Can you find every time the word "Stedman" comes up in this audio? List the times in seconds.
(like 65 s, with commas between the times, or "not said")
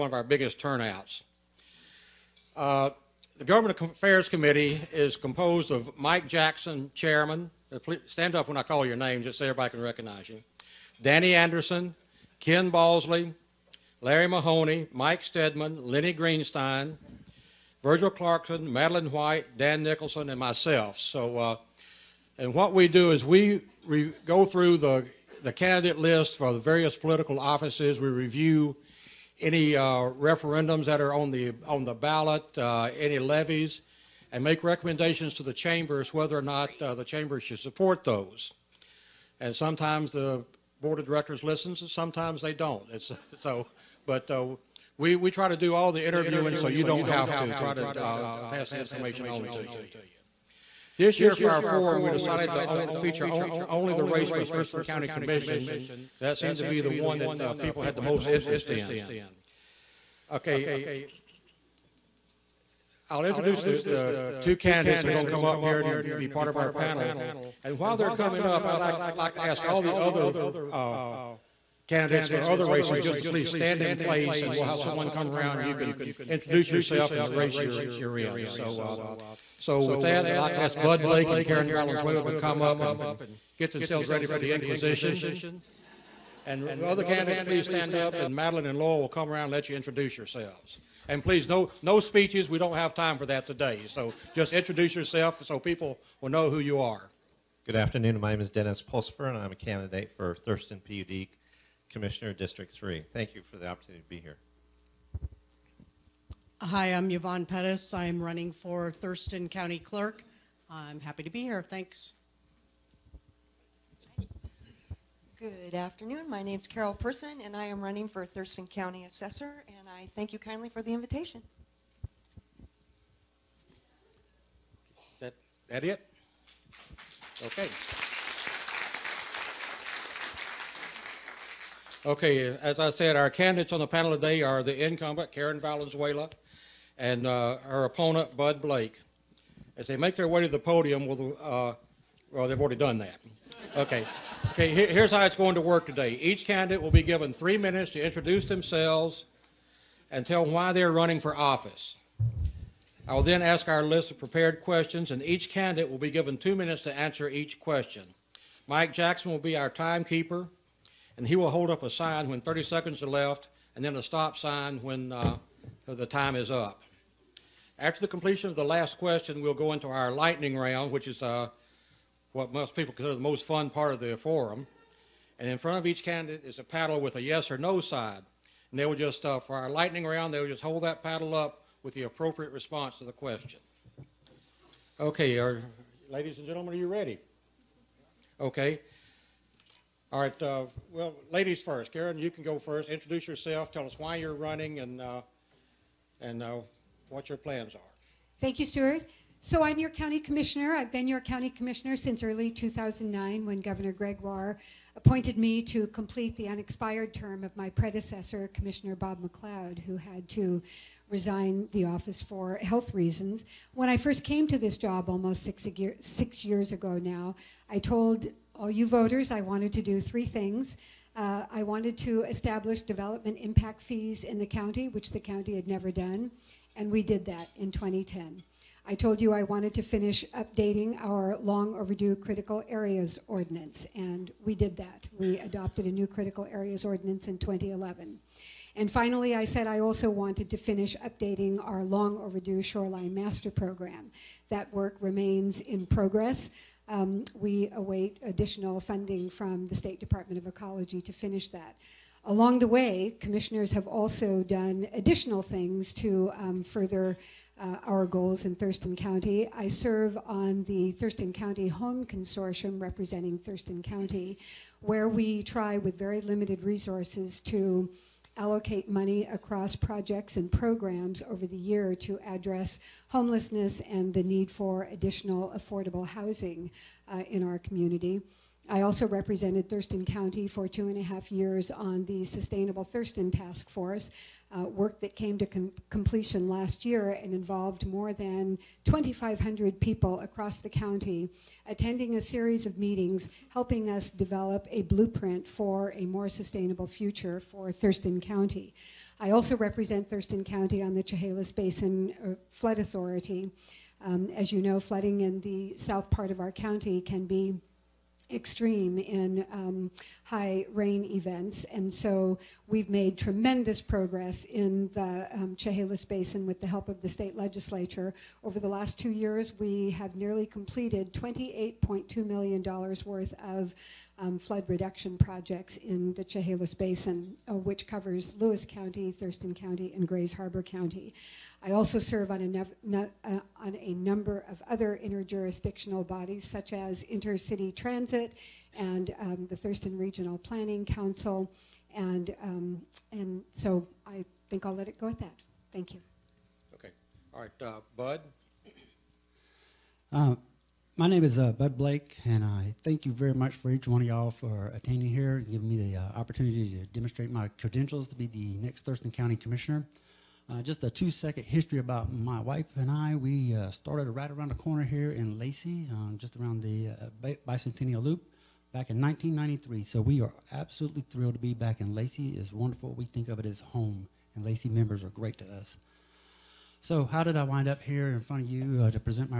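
15 s.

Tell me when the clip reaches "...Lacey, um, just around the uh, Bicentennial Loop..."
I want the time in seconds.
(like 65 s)
365 s.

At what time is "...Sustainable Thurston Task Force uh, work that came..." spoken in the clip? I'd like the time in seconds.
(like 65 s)
282 s.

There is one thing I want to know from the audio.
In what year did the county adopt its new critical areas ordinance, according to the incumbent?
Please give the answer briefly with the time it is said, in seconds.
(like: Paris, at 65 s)
2011, at 237 s.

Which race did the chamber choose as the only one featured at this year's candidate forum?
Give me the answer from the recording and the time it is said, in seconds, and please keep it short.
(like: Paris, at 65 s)
Thurston County Commission, at 54 s.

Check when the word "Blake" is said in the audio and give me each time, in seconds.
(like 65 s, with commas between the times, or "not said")
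81 s, 138 s, 351 s.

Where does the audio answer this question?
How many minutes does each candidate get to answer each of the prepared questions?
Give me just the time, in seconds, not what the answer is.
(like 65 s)
156 s.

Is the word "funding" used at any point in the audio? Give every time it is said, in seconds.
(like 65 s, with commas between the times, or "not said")
248 s.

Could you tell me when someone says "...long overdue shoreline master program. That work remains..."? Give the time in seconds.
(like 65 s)
241 s.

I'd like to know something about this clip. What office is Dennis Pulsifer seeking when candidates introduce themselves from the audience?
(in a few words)
Thurston PUD Commissioner District 3.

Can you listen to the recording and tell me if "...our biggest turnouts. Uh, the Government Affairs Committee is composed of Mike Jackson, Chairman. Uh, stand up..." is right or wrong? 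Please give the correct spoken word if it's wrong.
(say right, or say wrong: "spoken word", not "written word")
right.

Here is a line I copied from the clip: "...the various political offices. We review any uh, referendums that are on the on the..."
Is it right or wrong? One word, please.
right.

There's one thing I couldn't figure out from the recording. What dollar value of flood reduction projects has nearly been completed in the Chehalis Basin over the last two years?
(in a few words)
$28.2 million.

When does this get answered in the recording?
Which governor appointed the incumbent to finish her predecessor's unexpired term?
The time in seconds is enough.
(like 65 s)
203 s.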